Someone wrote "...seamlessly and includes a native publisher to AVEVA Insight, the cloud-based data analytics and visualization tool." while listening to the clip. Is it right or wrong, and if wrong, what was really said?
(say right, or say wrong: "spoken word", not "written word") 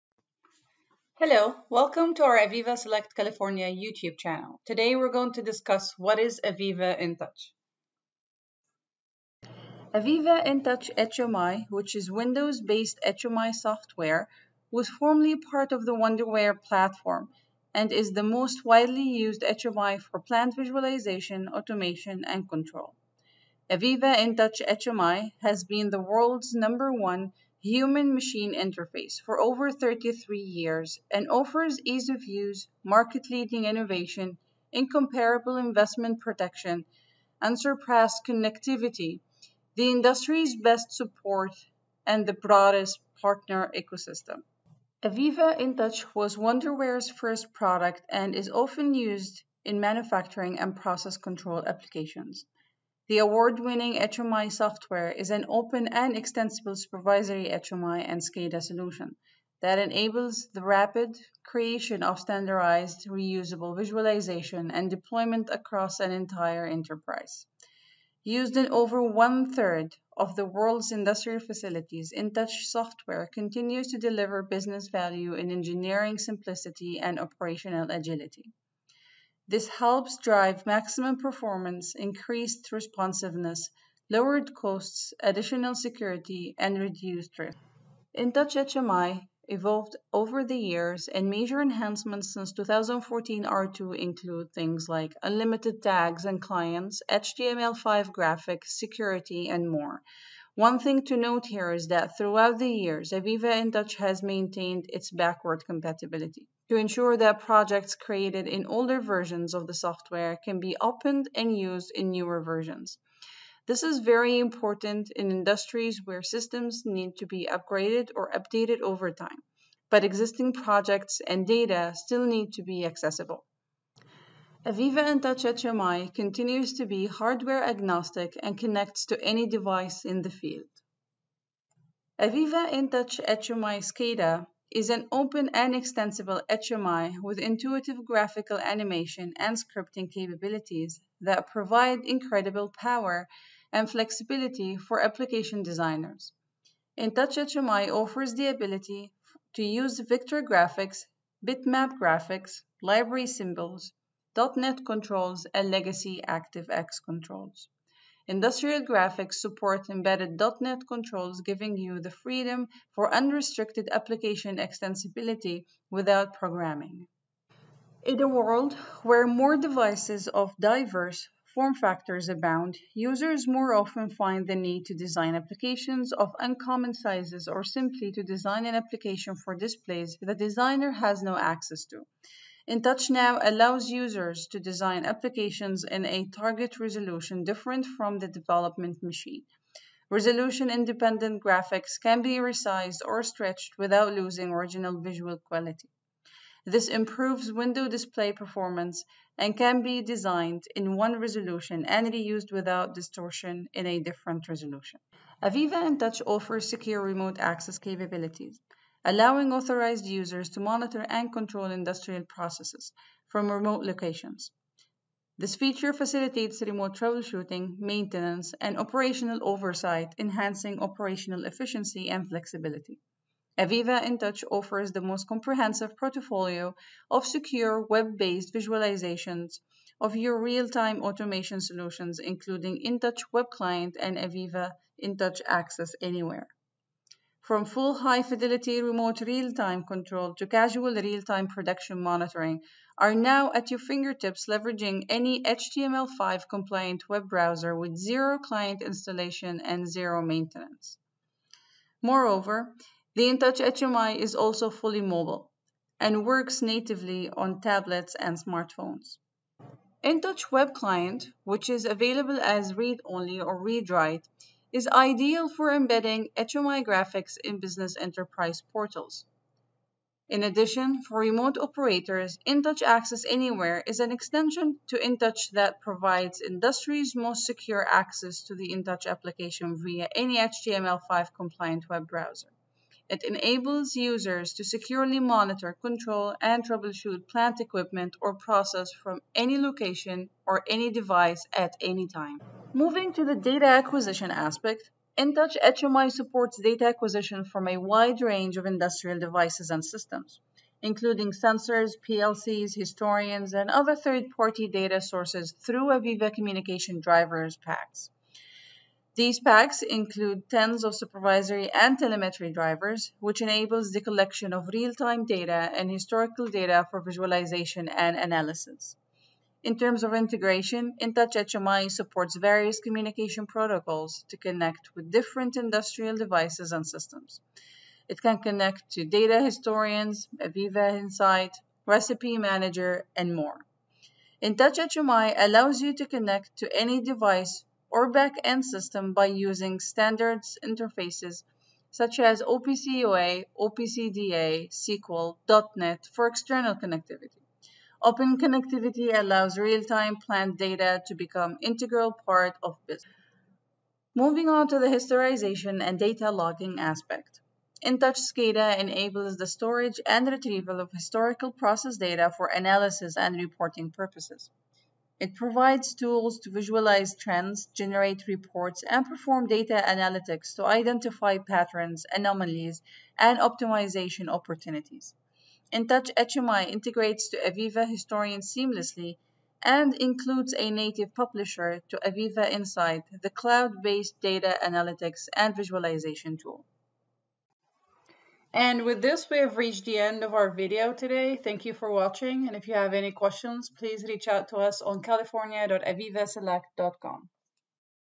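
right.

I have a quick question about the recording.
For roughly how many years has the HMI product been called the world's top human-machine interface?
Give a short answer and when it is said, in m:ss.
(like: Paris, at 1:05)
33, at 0:29.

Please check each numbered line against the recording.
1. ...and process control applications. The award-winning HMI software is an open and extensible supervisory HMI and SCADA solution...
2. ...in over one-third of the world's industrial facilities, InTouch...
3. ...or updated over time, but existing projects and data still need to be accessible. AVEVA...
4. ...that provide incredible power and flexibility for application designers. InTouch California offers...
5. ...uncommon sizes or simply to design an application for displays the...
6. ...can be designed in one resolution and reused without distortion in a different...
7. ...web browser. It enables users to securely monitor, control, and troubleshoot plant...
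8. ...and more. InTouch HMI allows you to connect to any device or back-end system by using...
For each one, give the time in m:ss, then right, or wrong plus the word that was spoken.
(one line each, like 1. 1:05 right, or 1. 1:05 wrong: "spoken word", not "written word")
1. 0:50 right
2. 1:08 right
3. 1:58 right
4. 2:21 wrong: "HMI", not "California"
5. 2:56 right
6. 3:19 right
7. 4:41 right
8. 5:33 right.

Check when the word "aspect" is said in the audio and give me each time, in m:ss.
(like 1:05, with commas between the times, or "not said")
4:54, 5:56.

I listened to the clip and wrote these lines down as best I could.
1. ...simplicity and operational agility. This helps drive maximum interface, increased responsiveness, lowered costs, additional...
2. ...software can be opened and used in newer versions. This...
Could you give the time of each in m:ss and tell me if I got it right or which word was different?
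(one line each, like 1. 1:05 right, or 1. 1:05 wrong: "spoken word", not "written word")
1. 1:16 wrong: "performance", not "interface"
2. 1:49 right.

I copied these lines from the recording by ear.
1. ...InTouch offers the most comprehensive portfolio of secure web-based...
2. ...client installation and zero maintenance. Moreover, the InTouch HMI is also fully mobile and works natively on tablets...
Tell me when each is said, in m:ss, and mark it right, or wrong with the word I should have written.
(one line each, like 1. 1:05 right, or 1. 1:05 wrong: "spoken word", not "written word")
1. 3:44 right
2. 4:08 right.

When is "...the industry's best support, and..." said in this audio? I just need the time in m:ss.
0:39.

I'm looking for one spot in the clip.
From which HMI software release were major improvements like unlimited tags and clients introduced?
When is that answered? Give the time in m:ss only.
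1:32.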